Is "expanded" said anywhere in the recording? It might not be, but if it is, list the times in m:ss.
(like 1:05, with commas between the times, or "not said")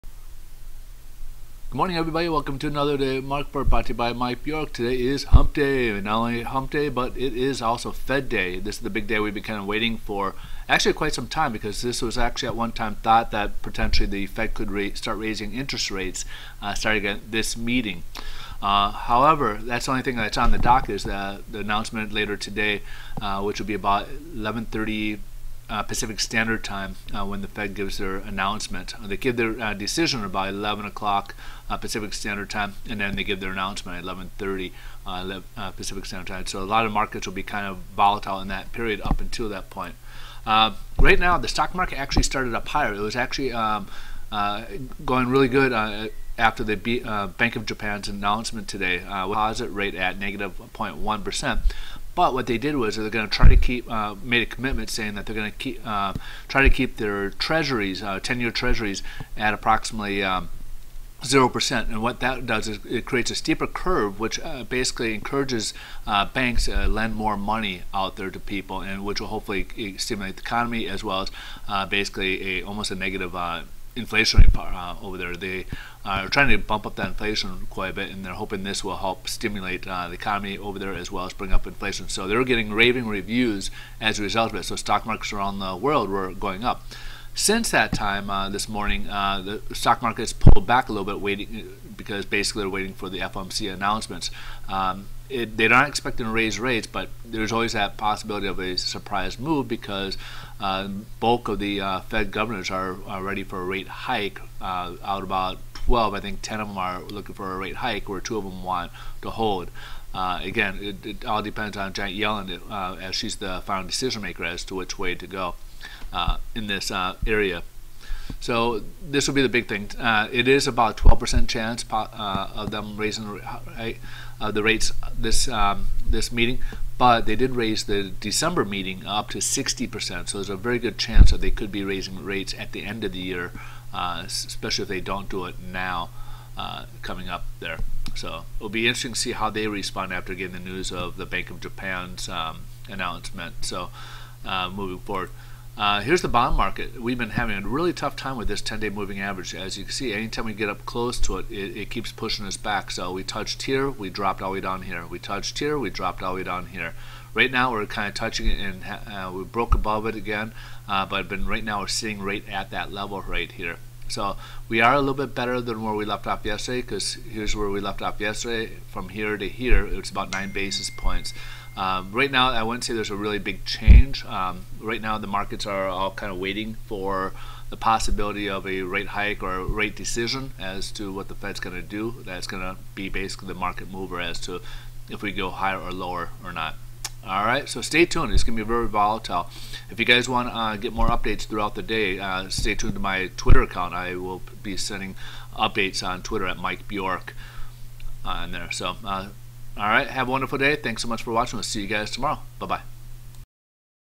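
not said.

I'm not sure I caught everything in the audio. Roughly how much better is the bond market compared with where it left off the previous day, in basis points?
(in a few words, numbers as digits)
9 basis points.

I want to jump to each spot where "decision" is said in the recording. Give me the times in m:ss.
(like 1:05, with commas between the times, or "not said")
0:29, 1:53, 2:59.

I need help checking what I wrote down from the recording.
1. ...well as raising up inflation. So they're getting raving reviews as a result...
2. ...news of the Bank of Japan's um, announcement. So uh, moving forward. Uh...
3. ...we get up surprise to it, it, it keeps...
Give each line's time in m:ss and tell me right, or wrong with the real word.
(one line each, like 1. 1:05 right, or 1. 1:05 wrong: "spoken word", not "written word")
1. 1:21 wrong: "bring", not "raising"
2. 2:20 right
3. 2:30 wrong: "close", not "surprise".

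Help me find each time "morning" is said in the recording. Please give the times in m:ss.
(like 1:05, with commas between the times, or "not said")
0:01, 1:28.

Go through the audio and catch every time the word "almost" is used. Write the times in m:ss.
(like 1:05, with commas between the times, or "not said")
1:12.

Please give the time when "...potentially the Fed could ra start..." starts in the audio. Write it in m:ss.
0:13.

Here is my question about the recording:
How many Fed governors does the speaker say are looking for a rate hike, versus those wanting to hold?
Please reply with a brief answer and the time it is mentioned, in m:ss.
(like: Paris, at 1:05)
10, at 1:46.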